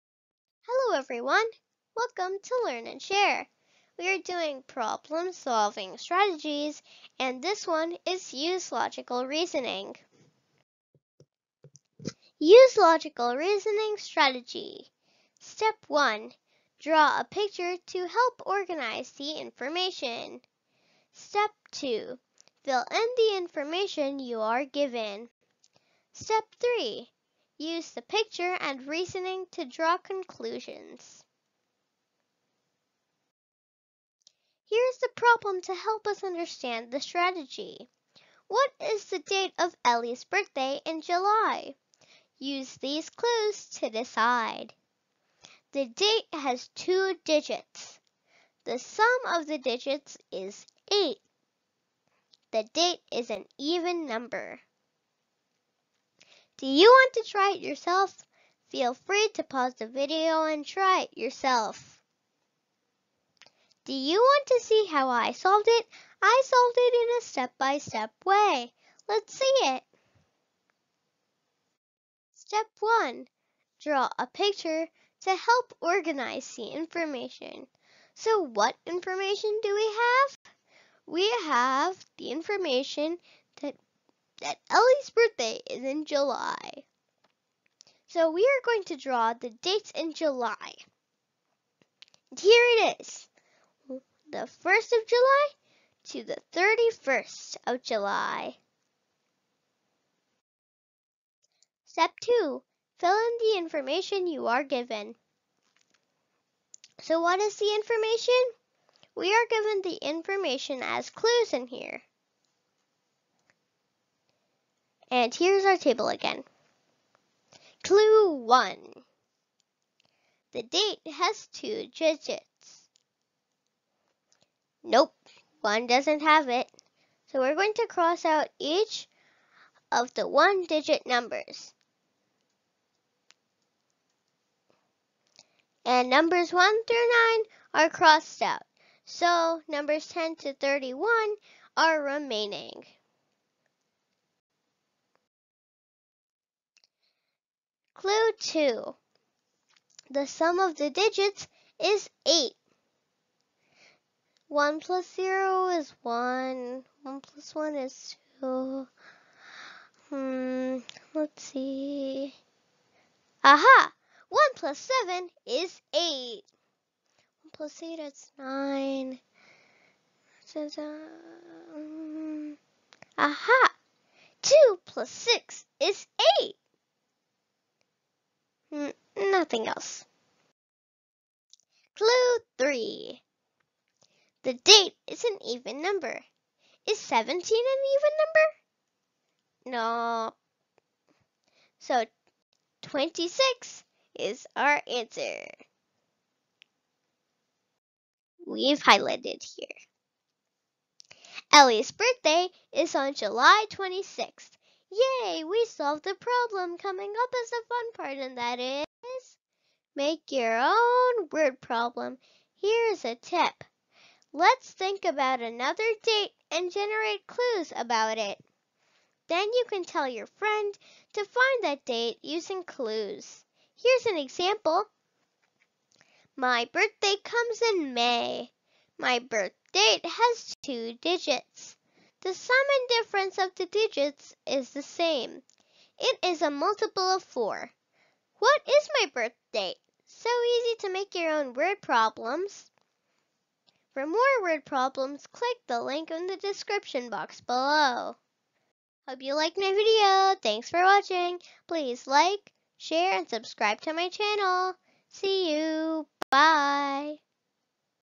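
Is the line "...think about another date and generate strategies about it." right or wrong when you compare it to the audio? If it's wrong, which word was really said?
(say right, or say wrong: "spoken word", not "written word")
wrong: "clues", not "strategies".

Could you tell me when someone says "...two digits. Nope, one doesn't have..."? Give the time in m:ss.
2:01.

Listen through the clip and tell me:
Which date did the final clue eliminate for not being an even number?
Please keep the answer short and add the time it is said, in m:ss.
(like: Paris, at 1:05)
17, at 3:06.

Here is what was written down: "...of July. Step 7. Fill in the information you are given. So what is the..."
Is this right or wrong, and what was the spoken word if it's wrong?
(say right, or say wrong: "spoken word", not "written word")
wrong: "2", not "7".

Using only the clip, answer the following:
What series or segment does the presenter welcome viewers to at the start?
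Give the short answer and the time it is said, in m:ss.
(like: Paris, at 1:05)
Learn and Share, at 0:02.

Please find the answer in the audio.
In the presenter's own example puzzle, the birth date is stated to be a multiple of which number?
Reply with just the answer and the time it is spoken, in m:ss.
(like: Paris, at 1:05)
4, at 3:57.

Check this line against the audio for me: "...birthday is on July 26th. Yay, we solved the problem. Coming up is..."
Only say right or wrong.
right.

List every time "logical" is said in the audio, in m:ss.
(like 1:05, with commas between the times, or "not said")
0:08, 0:12.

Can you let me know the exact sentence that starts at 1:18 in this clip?
So what information do we have?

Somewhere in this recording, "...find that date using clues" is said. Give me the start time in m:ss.
3:41.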